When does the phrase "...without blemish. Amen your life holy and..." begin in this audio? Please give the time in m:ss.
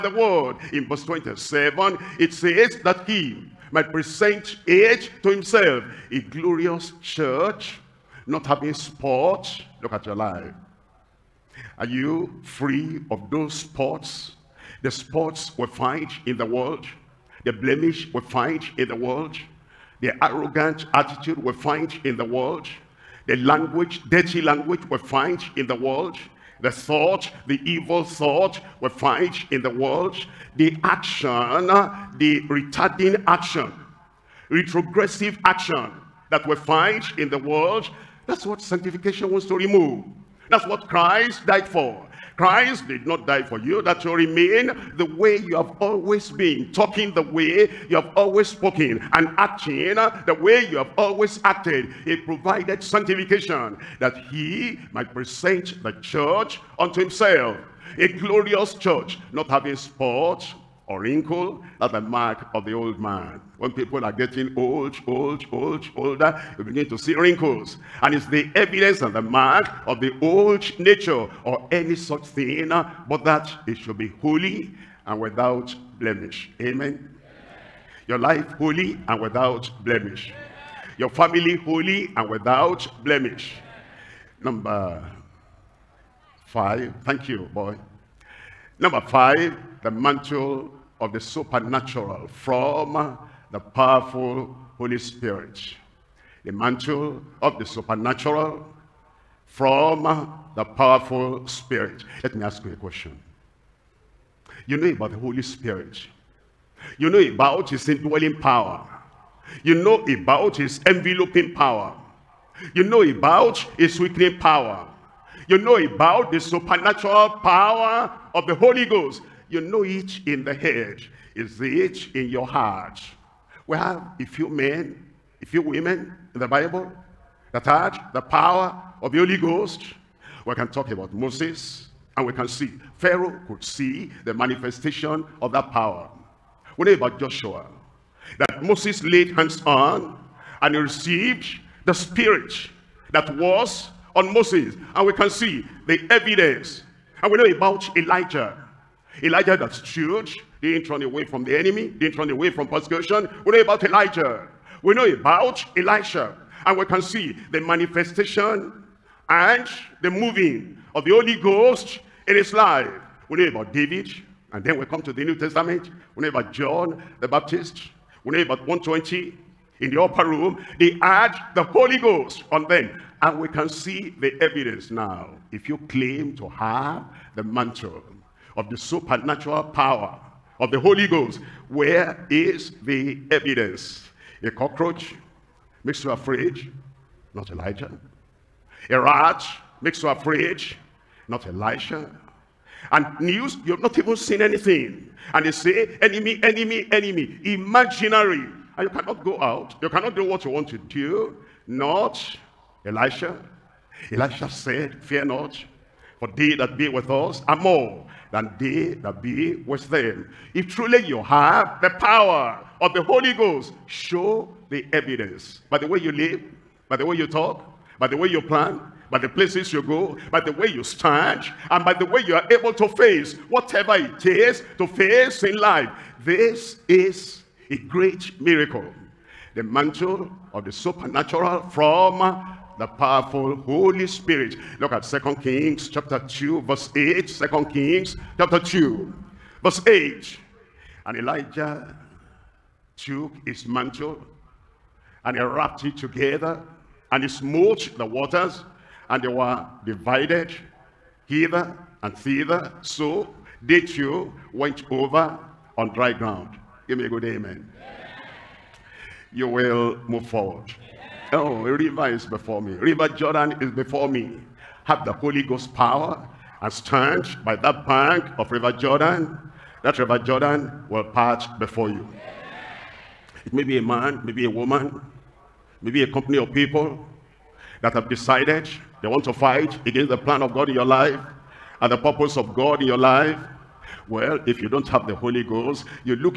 1:15.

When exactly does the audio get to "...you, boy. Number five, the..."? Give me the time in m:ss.
1:27.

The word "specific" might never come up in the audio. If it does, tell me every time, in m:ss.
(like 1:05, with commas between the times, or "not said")
not said.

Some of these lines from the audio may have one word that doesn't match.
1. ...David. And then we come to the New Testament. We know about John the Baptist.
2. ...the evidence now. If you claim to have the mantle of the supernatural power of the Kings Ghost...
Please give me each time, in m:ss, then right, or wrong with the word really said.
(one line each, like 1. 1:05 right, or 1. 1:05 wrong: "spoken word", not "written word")
1. 2:43 right
2. 2:54 wrong: "Holy", not "Kings".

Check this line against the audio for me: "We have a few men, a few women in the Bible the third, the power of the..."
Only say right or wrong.
right.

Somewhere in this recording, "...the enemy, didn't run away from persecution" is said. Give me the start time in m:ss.
2:31.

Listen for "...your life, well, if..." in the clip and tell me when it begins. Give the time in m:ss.
4:42.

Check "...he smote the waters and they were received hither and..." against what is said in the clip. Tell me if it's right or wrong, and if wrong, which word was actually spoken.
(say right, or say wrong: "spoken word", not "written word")
wrong: "divided", not "received".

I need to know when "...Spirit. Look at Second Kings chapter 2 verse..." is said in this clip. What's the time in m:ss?
3:54.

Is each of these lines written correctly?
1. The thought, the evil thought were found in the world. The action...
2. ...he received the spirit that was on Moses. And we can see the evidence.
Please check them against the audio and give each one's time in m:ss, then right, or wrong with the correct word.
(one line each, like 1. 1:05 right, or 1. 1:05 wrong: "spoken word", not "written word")
1. 0:26 right
2. 2:20 right.